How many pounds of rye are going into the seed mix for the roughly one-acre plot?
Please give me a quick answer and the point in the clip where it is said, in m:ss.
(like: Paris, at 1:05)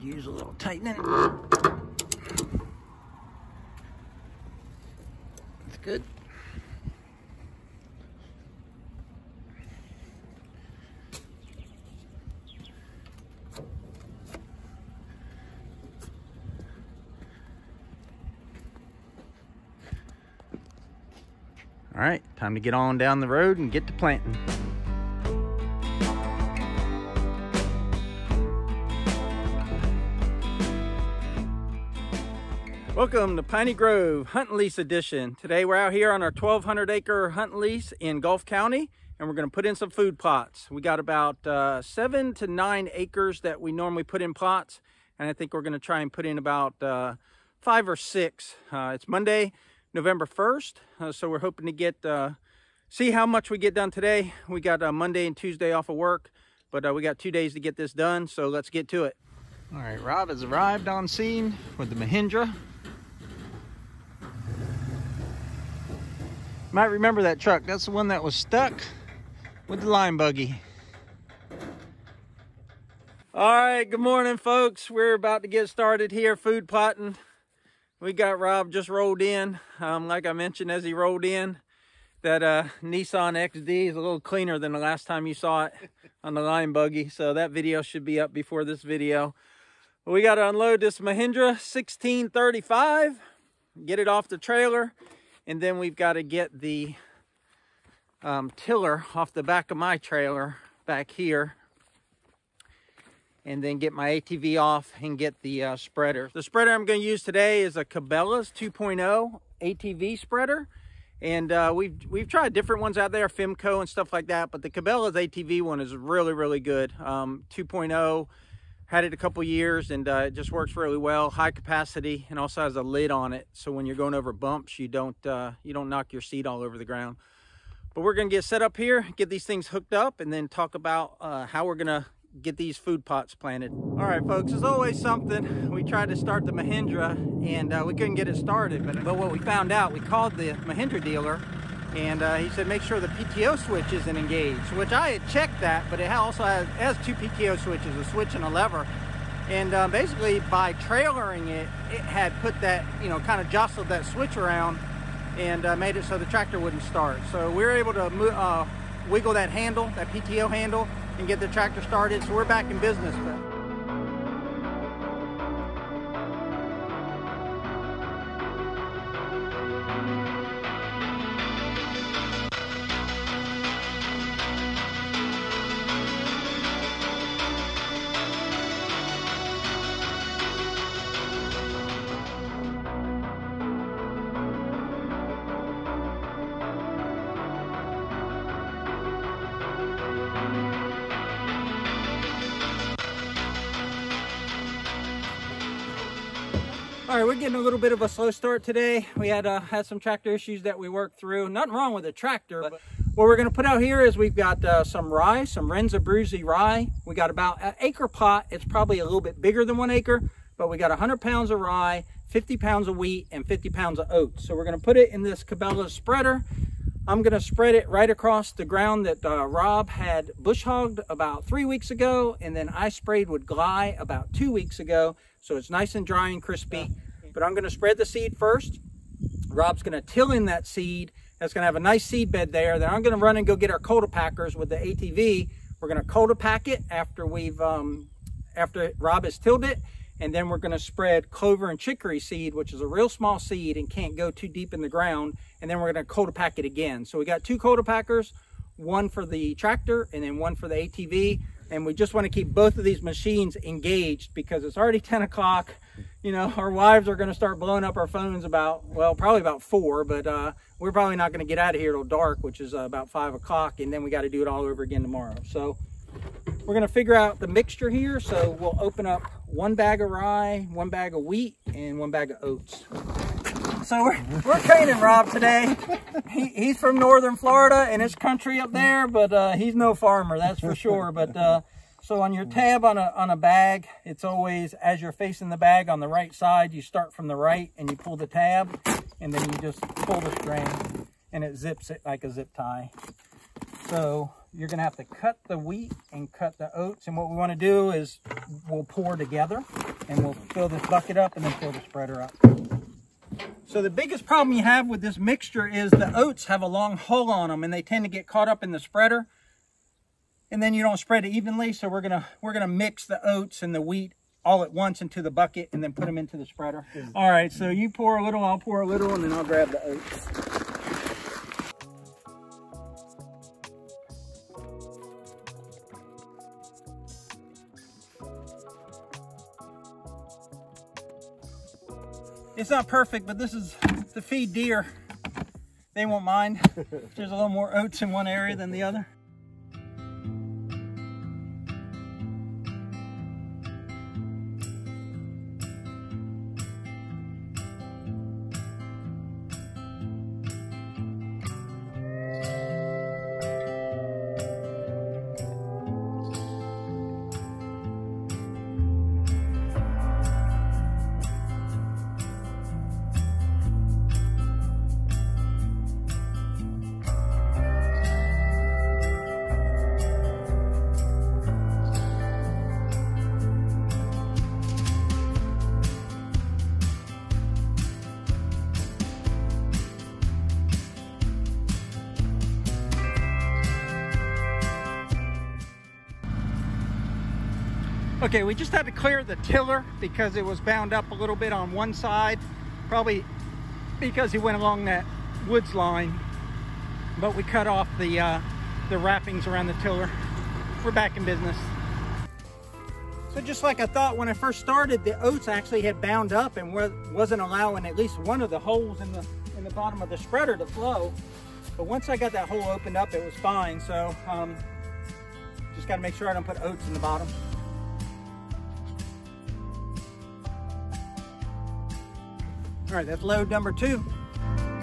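100 pounds, at 3:30.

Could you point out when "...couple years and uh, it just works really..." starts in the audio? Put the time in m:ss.
1:59.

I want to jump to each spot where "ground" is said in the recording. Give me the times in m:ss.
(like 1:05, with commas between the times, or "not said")
2:06, 3:38, 4:04.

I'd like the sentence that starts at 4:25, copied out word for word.
So we're going to figure out the mixture here.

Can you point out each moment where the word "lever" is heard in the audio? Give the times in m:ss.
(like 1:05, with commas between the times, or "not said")
2:28.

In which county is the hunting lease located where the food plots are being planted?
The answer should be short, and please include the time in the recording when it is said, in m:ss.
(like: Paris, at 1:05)
Gulf County, at 0:38.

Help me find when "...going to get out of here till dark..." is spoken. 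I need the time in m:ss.
4:21.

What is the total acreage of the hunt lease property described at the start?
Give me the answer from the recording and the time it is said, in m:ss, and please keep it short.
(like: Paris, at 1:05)
1,200 acres, at 0:36.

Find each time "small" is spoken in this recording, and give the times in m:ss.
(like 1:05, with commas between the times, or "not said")
4:03.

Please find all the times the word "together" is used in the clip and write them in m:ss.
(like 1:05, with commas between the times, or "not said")
4:59.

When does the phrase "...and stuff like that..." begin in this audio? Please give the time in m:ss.
1:53.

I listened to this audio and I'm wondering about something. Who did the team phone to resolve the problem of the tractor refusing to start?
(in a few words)
Mahindra dealer.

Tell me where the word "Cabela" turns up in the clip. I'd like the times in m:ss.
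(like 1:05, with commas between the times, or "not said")
1:47, 1:54, 3:35.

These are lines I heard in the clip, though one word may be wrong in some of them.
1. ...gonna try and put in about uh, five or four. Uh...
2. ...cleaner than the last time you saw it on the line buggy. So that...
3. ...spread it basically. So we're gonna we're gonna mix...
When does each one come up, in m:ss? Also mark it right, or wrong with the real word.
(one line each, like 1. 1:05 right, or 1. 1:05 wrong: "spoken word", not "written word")
1. 0:45 wrong: "six", not "four"
2. 1:24 right
3. 5:10 wrong: "evenly", not "basically".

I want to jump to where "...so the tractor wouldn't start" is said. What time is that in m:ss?
2:36.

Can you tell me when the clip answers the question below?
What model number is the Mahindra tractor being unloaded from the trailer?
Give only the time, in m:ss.
1:31.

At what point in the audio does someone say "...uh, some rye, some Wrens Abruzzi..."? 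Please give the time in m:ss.
3:24.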